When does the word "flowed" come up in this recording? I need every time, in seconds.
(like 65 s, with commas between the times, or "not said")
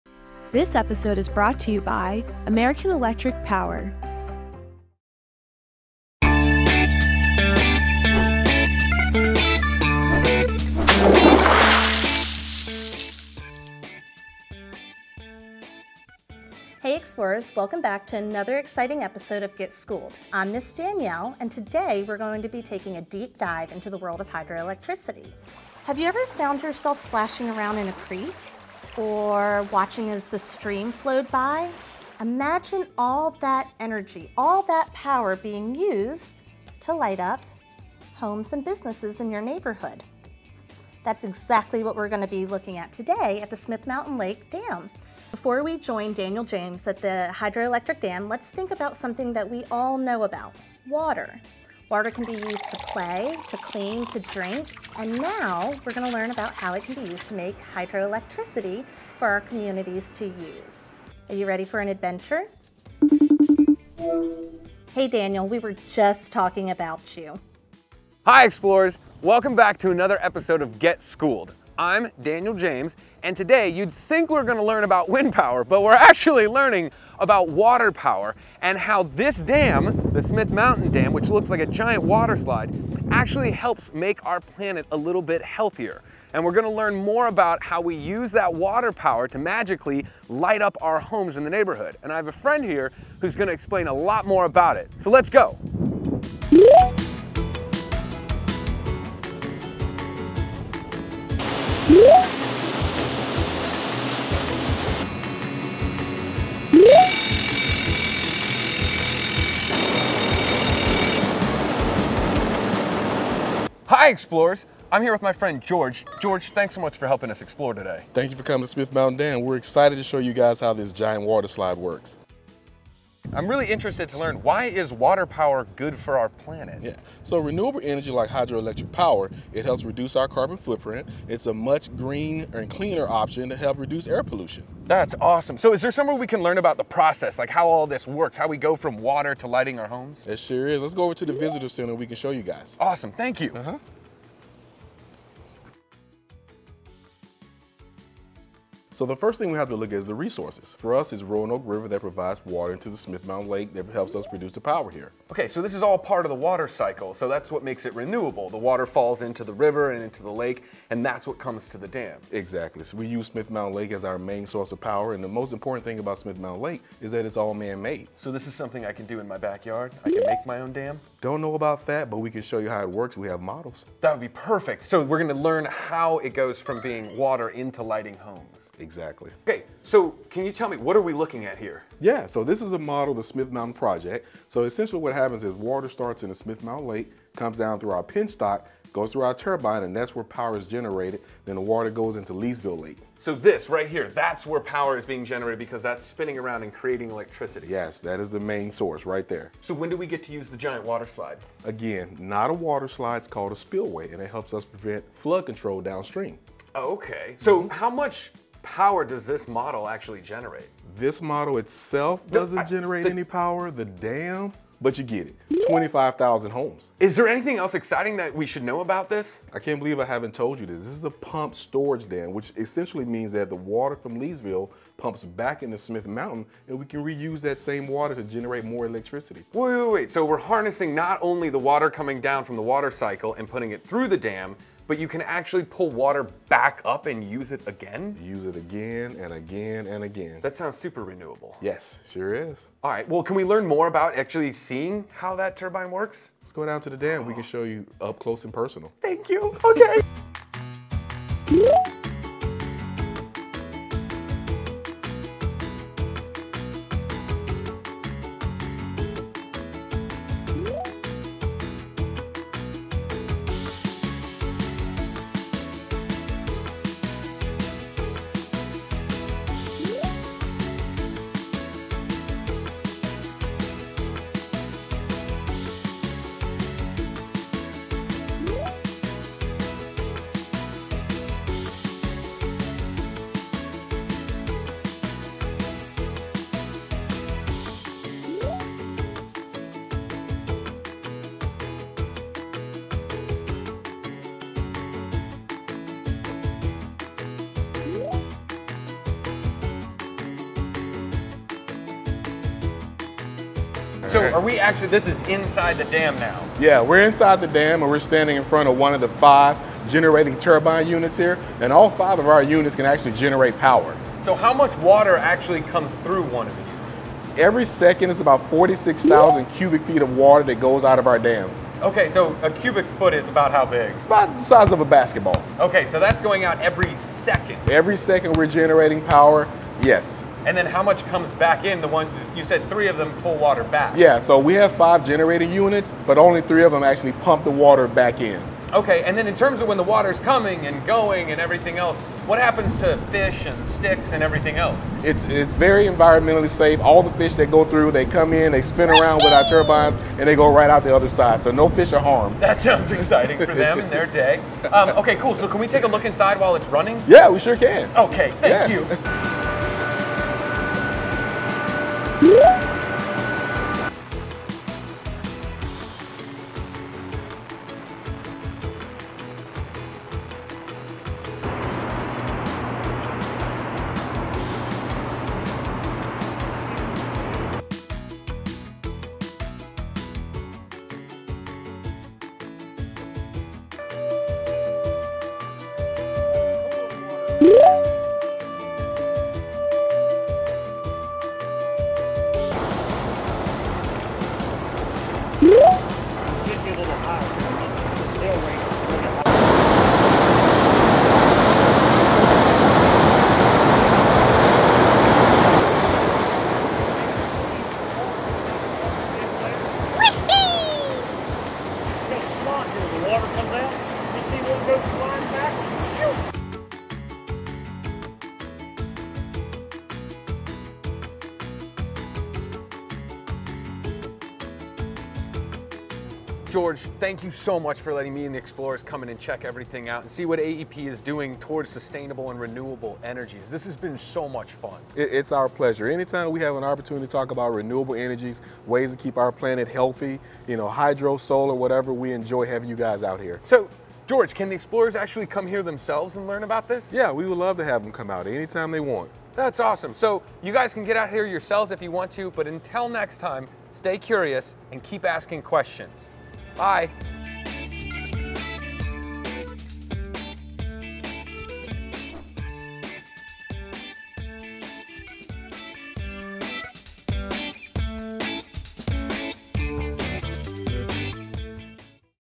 30 s.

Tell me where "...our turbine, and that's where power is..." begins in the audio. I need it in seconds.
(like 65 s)
189 s.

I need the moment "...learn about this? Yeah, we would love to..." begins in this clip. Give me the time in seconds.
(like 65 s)
446 s.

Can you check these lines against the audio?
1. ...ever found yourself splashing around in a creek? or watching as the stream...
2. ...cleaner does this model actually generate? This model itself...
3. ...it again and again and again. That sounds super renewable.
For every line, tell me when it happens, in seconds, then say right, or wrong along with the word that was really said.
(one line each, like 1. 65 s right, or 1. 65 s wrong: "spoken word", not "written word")
1. 26 s right
2. 208 s wrong: "power", not "cleaner"
3. 238 s right.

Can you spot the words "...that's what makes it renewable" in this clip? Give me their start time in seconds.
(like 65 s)
157 s.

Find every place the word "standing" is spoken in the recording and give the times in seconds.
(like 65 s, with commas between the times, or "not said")
307 s.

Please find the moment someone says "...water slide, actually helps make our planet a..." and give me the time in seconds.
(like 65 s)
82 s.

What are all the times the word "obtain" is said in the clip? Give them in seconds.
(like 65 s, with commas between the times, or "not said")
not said.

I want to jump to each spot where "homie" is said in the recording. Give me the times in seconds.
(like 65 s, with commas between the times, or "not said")
not said.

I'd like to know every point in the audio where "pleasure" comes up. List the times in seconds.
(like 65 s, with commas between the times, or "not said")
435 s.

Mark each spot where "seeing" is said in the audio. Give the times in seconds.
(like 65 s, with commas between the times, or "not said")
244 s.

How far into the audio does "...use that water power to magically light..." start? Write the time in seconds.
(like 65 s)
87 s.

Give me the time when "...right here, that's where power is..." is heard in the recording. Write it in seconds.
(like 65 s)
193 s.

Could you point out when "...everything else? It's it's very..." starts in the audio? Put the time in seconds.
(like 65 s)
344 s.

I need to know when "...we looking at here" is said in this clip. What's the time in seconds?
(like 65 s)
181 s.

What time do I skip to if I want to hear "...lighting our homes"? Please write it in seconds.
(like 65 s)
139 s.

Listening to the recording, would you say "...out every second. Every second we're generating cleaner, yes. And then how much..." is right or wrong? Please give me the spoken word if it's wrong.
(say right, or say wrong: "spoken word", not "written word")
wrong: "power", not "cleaner".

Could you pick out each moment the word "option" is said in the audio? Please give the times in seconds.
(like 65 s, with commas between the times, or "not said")
133 s.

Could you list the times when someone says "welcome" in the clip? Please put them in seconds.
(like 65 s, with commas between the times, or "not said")
17 s, 69 s.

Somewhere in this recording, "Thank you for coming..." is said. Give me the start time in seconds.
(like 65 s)
118 s.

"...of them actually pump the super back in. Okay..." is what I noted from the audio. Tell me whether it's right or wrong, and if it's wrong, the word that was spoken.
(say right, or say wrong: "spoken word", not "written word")
wrong: "water", not "super".